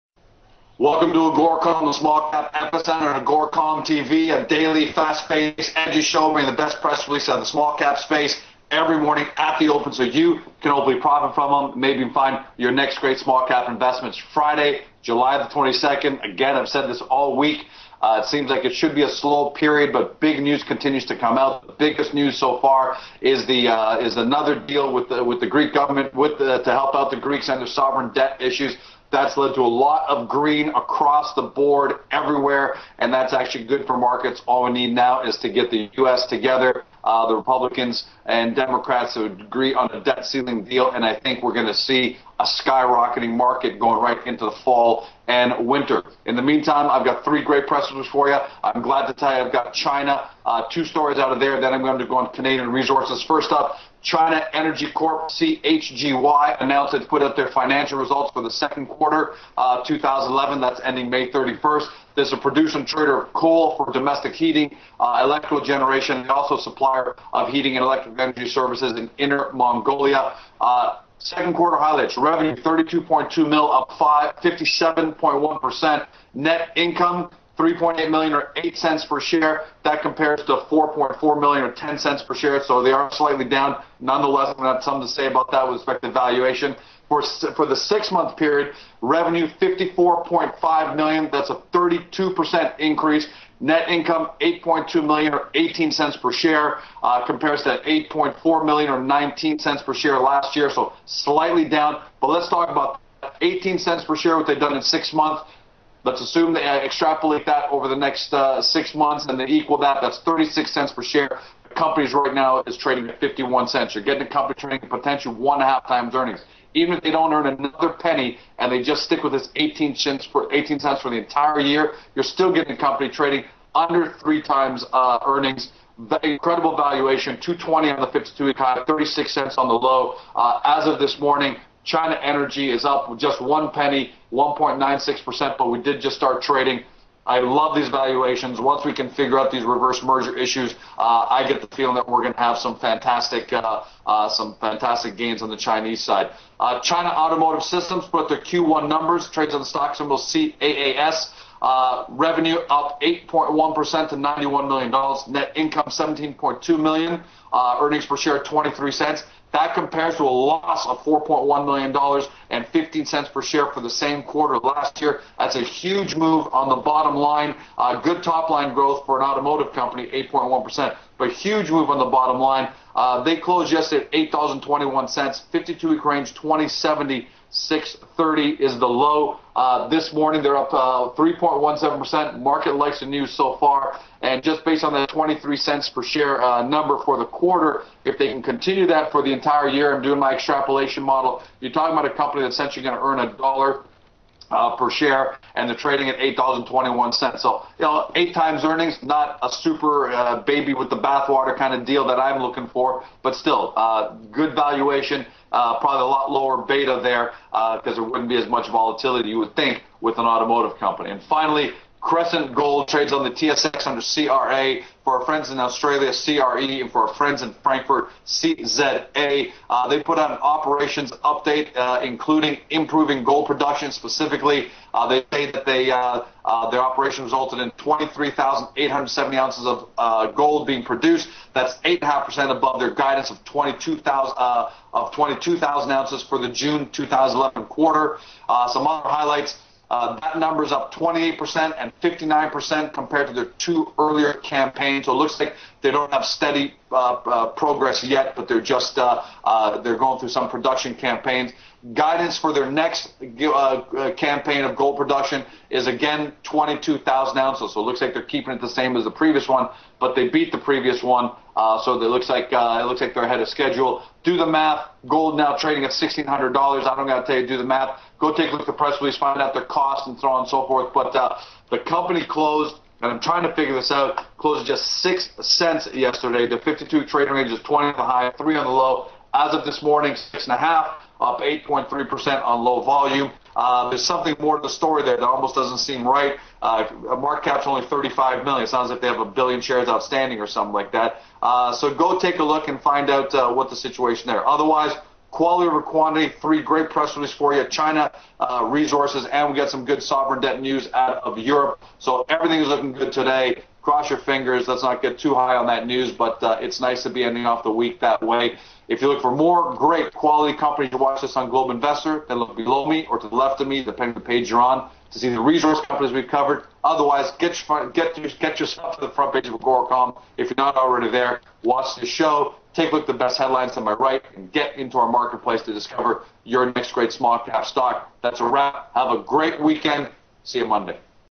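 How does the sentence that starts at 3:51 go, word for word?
That's 8.5% above their guidance of 22,000 of 22,000 ounces for the June 2011 quarter.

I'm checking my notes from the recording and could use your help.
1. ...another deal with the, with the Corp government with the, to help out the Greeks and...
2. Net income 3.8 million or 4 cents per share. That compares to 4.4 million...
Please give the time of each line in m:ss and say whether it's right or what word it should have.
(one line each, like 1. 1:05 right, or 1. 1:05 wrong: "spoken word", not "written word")
1. 0:24 wrong: "Greek", not "Corp"
2. 1:16 wrong: "8", not "4".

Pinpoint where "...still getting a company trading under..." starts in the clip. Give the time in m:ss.
2:02.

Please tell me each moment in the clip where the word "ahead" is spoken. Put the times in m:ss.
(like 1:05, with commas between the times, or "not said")
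4:23.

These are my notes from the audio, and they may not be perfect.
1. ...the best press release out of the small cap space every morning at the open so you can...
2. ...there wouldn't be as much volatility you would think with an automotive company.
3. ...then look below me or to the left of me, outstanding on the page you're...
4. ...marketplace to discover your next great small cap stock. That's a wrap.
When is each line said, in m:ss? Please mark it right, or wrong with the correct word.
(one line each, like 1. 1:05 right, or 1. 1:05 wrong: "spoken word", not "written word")
1. 0:06 right
2. 3:27 right
3. 5:12 wrong: "depending", not "outstanding"
4. 5:25 right.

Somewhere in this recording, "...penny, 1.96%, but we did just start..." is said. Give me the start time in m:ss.
2:13.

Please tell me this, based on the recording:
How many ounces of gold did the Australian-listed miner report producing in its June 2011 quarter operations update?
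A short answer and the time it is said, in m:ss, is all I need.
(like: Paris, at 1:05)
23,870, at 3:47.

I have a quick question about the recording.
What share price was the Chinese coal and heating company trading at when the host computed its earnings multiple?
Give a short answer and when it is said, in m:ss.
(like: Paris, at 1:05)
51 cents, at 1:53.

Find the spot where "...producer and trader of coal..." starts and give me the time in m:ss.
1:02.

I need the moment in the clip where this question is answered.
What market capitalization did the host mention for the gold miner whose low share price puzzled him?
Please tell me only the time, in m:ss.
4:47.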